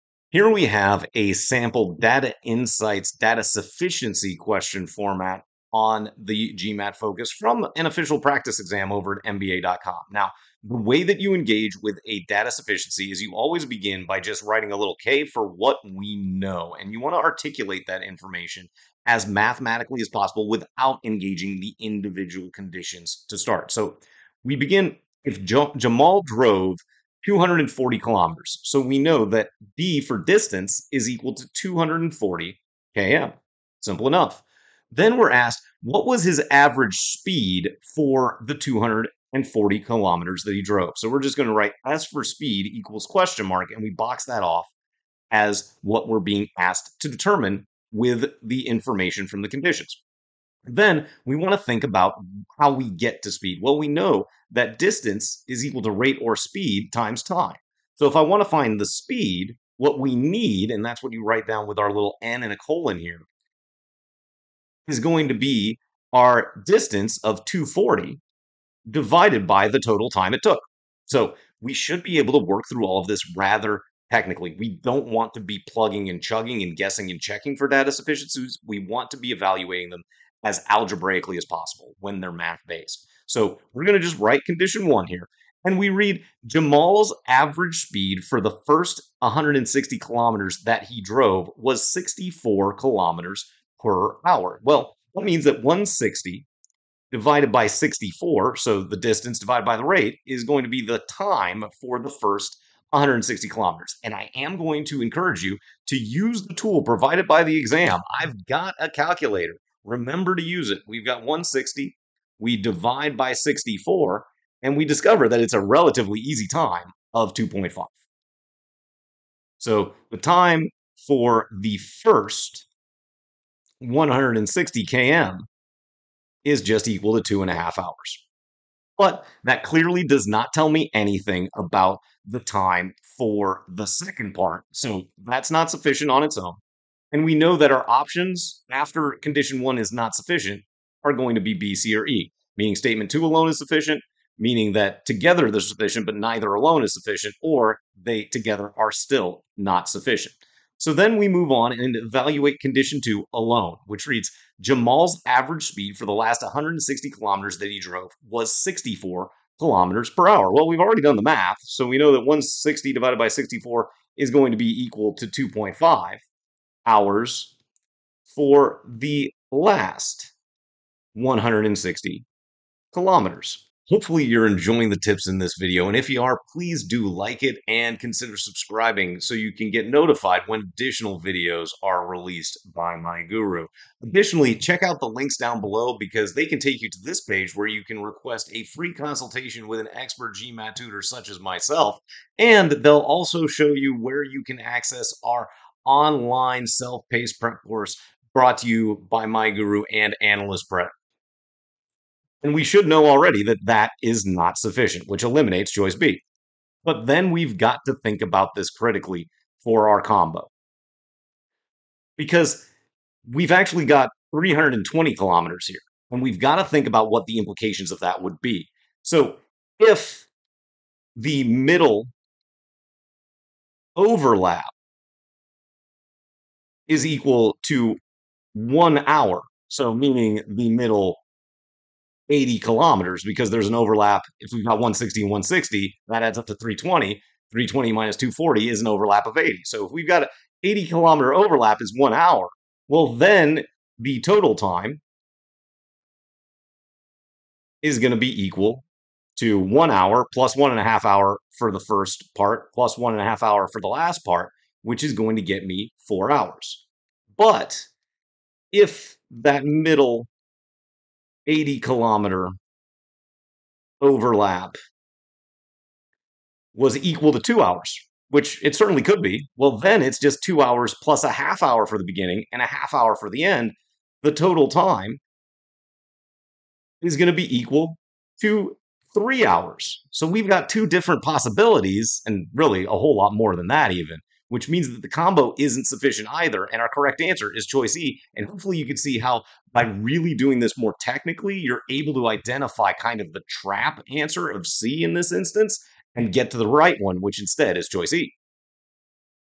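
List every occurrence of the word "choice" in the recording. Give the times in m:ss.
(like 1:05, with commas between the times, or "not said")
3:25, 4:47, 4:57.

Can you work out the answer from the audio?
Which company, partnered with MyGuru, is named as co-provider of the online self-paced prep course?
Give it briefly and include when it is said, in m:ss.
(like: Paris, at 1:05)
Analyst Prep, at 3:20.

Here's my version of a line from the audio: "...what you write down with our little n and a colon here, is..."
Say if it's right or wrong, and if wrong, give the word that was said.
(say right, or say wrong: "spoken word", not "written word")
right.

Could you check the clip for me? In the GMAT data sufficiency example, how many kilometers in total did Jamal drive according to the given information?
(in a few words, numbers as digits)
240 km.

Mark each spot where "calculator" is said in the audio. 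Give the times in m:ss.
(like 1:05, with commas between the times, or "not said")
1:48.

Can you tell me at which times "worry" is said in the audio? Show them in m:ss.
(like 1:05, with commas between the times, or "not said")
not said.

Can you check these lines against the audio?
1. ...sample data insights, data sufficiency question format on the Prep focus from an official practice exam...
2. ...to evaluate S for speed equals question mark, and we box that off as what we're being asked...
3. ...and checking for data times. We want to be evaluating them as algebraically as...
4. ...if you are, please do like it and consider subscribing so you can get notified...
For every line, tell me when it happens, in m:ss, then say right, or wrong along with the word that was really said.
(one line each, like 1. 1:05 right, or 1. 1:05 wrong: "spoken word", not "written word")
1. 0:01 wrong: "GMAT", not "Prep"
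2. 0:41 wrong: "write", not "evaluate"
3. 1:17 wrong: "sufficiencies", not "times"
4. 2:55 right.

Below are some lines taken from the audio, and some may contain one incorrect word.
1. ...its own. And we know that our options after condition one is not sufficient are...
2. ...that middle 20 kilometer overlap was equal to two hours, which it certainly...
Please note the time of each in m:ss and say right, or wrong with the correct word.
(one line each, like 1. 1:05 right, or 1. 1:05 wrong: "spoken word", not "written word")
1. 2:16 right
2. 4:19 wrong: "80", not "20".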